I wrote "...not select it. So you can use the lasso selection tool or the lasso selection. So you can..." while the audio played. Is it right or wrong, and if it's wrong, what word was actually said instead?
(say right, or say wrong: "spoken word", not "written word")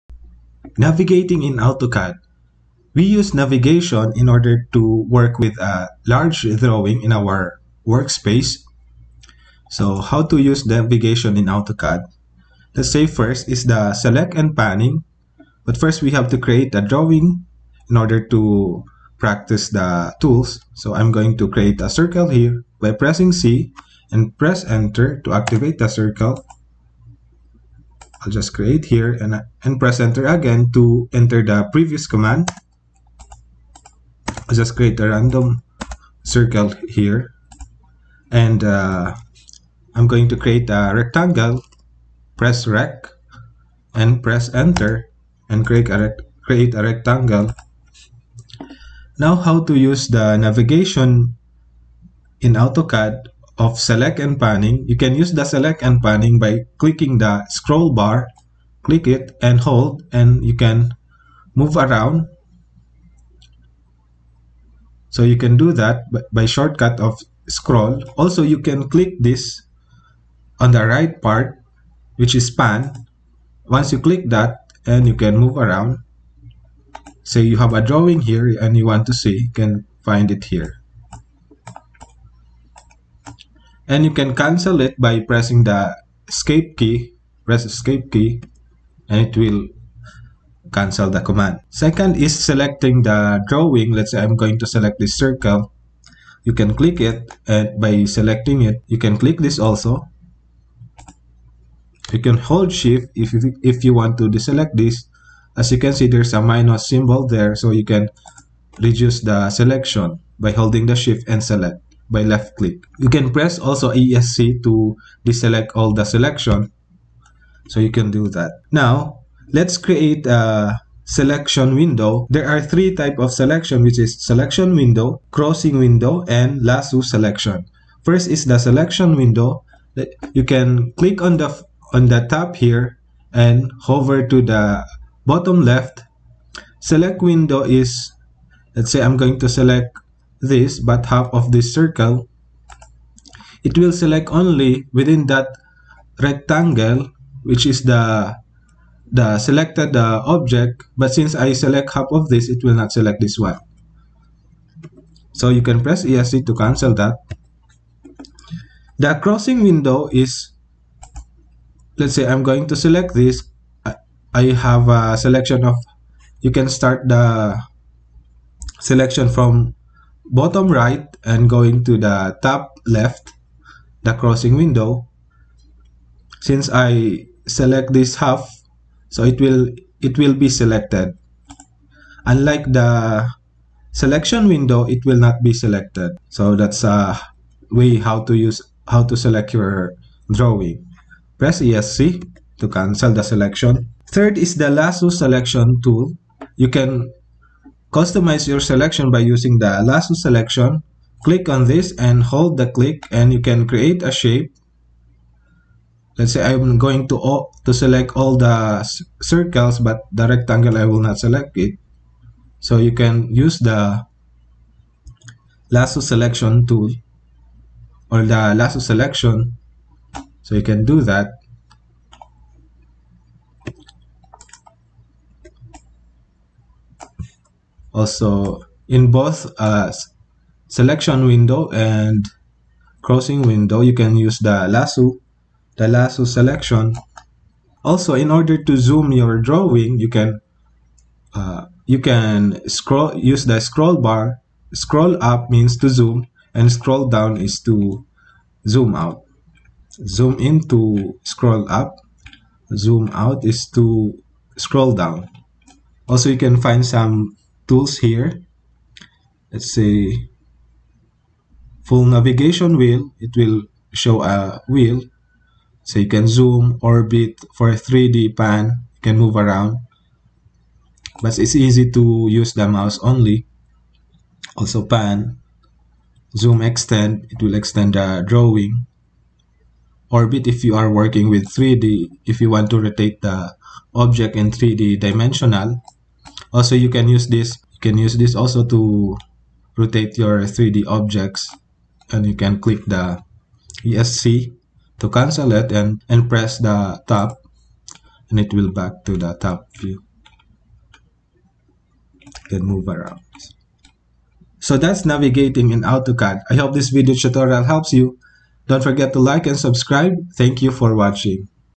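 right.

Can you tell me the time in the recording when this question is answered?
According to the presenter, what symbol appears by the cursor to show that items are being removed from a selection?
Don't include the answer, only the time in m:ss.
1:46.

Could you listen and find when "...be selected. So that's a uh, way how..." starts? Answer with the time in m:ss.
3:05.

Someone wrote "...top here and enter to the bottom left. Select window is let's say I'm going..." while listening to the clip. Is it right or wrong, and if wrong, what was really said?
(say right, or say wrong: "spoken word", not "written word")
wrong: "hover", not "enter".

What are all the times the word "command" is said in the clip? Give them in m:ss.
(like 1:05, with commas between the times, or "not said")
0:32, 1:31.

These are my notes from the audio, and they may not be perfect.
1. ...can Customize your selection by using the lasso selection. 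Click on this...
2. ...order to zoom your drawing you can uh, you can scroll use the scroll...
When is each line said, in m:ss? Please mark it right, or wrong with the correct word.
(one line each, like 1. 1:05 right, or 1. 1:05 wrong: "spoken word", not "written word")
1. 3:16 right
2. 3:58 right.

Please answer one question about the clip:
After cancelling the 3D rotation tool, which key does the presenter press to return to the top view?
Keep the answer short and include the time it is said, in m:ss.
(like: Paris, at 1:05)
Tab, at 4:57.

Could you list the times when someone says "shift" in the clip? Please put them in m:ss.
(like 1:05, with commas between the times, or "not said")
1:42, 1:50.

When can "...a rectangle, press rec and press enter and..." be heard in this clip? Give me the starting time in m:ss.
0:40.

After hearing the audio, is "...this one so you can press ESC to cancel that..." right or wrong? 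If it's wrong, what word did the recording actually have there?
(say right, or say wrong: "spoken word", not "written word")
right.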